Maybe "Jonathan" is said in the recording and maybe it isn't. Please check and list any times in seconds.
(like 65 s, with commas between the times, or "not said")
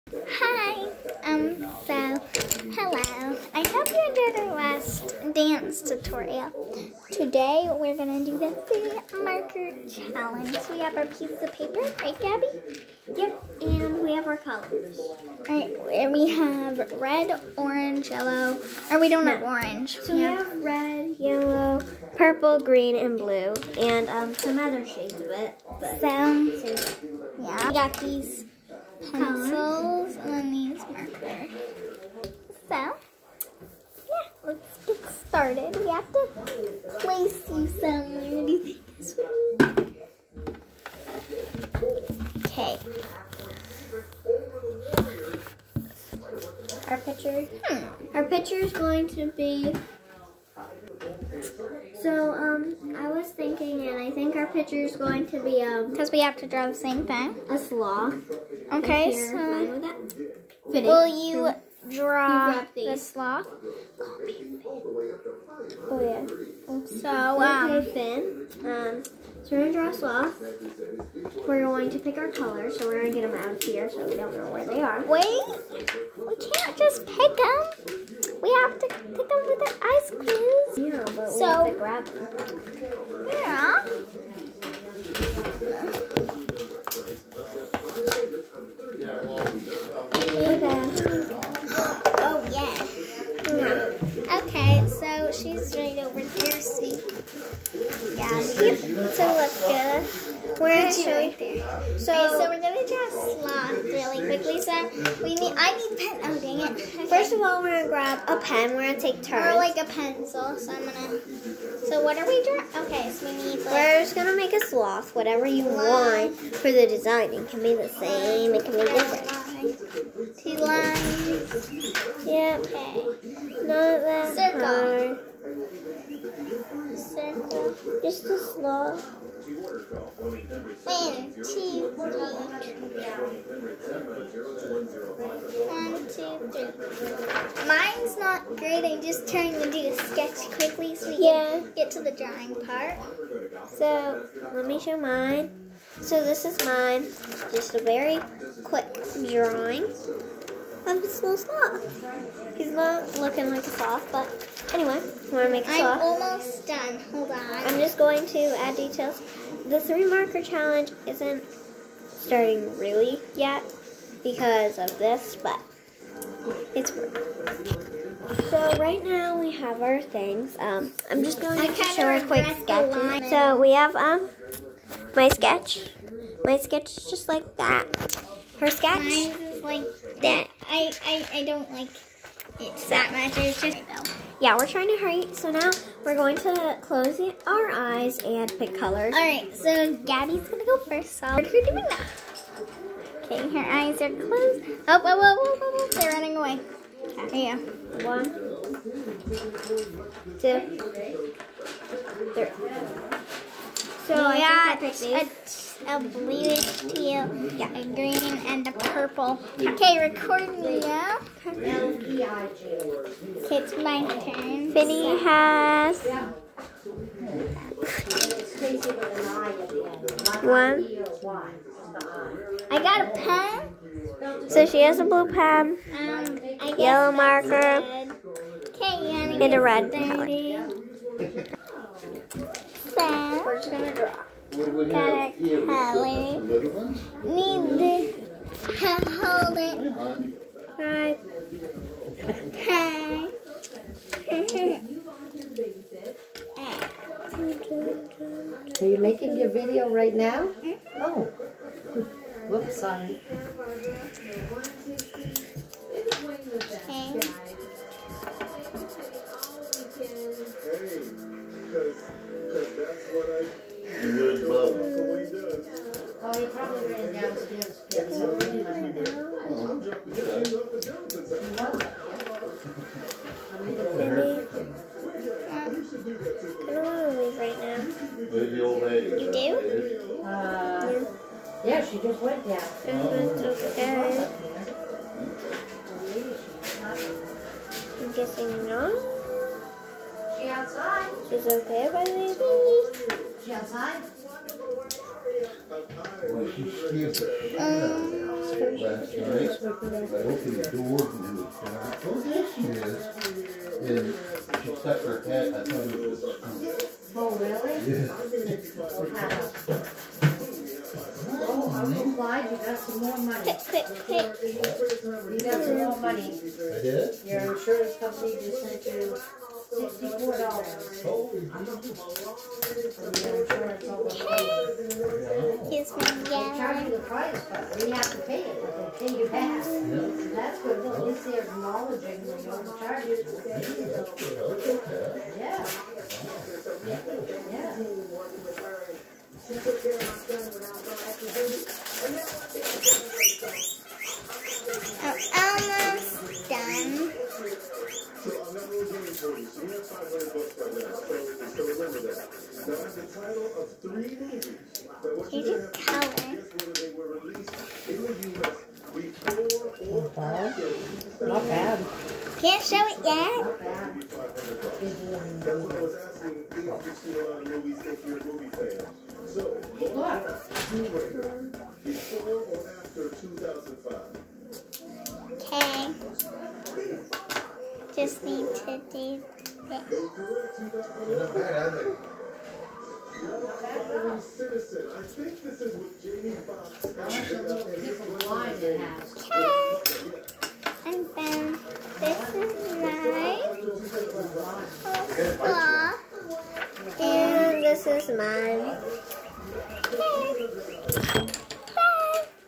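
not said.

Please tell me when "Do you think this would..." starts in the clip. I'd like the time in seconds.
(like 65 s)
38 s.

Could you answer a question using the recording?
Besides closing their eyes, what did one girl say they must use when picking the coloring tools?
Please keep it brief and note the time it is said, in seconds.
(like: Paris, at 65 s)
Ice cubes, at 79 s.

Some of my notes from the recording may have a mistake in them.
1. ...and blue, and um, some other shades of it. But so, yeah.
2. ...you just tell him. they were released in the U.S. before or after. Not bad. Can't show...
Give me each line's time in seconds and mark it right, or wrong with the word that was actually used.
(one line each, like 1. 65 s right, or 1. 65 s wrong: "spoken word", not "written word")
1. 22 s right
2. 355 s right.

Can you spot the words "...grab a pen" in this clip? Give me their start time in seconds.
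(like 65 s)
107 s.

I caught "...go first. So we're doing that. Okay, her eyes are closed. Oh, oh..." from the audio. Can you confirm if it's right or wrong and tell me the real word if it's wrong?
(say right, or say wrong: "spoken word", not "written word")
right.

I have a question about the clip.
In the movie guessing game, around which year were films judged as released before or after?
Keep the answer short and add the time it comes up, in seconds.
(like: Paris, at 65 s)
2005, at 373 s.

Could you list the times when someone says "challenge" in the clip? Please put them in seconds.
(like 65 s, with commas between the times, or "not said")
9 s, 160 s.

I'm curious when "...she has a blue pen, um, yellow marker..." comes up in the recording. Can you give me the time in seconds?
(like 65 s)
224 s.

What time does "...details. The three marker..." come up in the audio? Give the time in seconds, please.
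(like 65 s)
158 s.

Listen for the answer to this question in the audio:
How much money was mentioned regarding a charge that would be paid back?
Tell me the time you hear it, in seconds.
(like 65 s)
319 s.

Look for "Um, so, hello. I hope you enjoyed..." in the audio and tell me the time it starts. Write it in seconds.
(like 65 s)
1 s.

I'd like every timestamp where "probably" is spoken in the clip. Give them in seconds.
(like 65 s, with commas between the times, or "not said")
266 s.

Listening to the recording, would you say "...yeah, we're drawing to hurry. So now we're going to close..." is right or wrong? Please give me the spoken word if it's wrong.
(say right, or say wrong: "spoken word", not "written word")
wrong: "trying", not "drawing".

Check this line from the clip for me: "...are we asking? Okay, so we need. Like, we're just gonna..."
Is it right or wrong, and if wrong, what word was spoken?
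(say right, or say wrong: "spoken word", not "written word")
wrong: "drawing", not "asking".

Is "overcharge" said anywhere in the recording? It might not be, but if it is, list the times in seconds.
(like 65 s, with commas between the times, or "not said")
332 s.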